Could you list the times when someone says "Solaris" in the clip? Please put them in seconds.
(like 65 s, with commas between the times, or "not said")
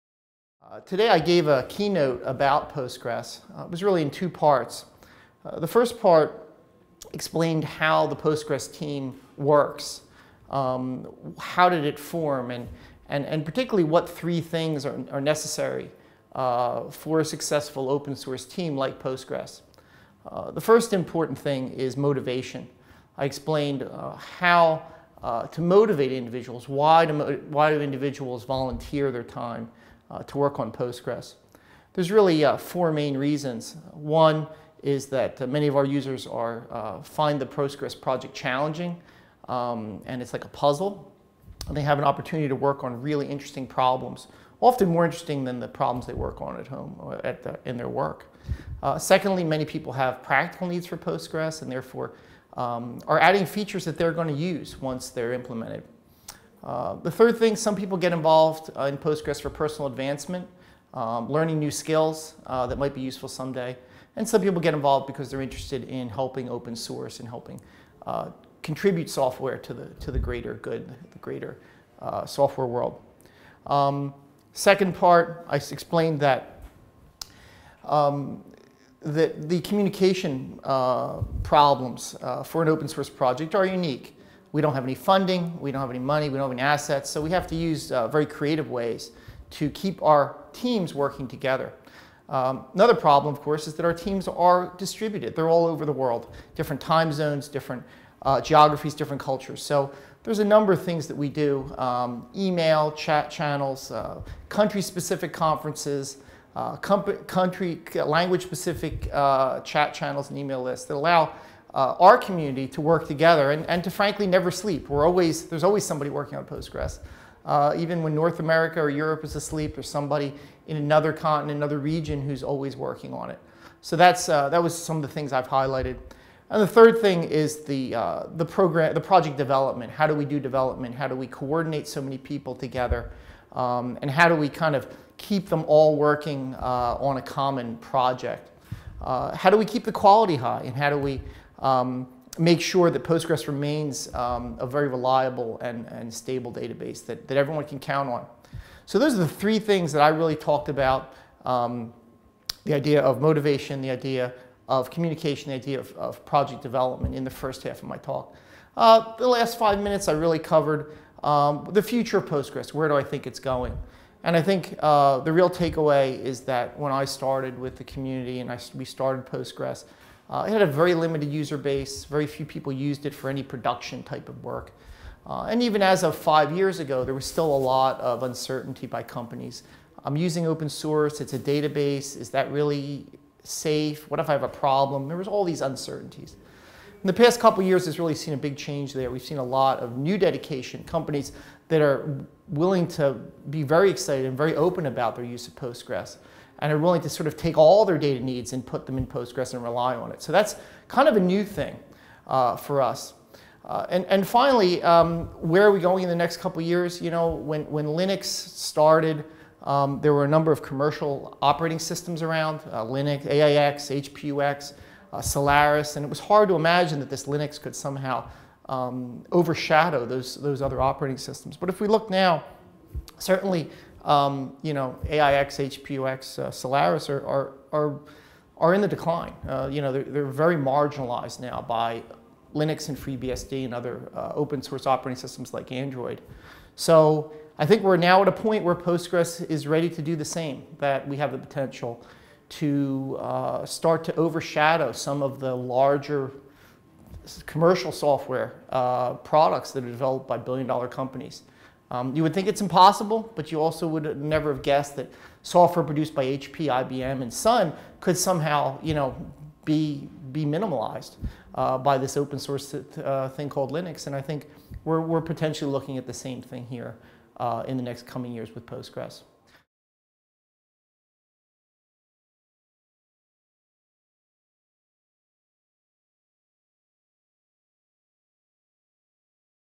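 215 s, 226 s.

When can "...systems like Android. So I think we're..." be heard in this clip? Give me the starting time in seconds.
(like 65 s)
235 s.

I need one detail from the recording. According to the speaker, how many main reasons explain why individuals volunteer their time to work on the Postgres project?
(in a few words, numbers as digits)
4.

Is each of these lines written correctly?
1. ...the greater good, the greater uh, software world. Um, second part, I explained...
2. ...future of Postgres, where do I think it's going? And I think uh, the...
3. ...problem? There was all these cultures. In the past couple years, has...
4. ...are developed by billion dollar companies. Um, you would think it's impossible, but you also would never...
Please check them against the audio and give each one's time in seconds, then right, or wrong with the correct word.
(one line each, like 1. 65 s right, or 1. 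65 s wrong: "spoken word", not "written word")
1. 70 s right
2. 161 s right
3. 184 s wrong: "uncertainties", not "cultures"
4. 249 s right.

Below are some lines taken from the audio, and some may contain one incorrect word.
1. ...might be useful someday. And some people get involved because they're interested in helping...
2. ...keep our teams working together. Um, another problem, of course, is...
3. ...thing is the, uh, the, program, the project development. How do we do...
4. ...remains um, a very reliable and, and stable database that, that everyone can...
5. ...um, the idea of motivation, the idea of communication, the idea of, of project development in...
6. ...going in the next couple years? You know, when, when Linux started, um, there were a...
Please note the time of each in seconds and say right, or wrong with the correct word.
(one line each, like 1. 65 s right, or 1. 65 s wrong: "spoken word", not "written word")
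1. 62 s right
2. 89 s right
3. 126 s right
4. 143 s right
5. 151 s right
6. 205 s right.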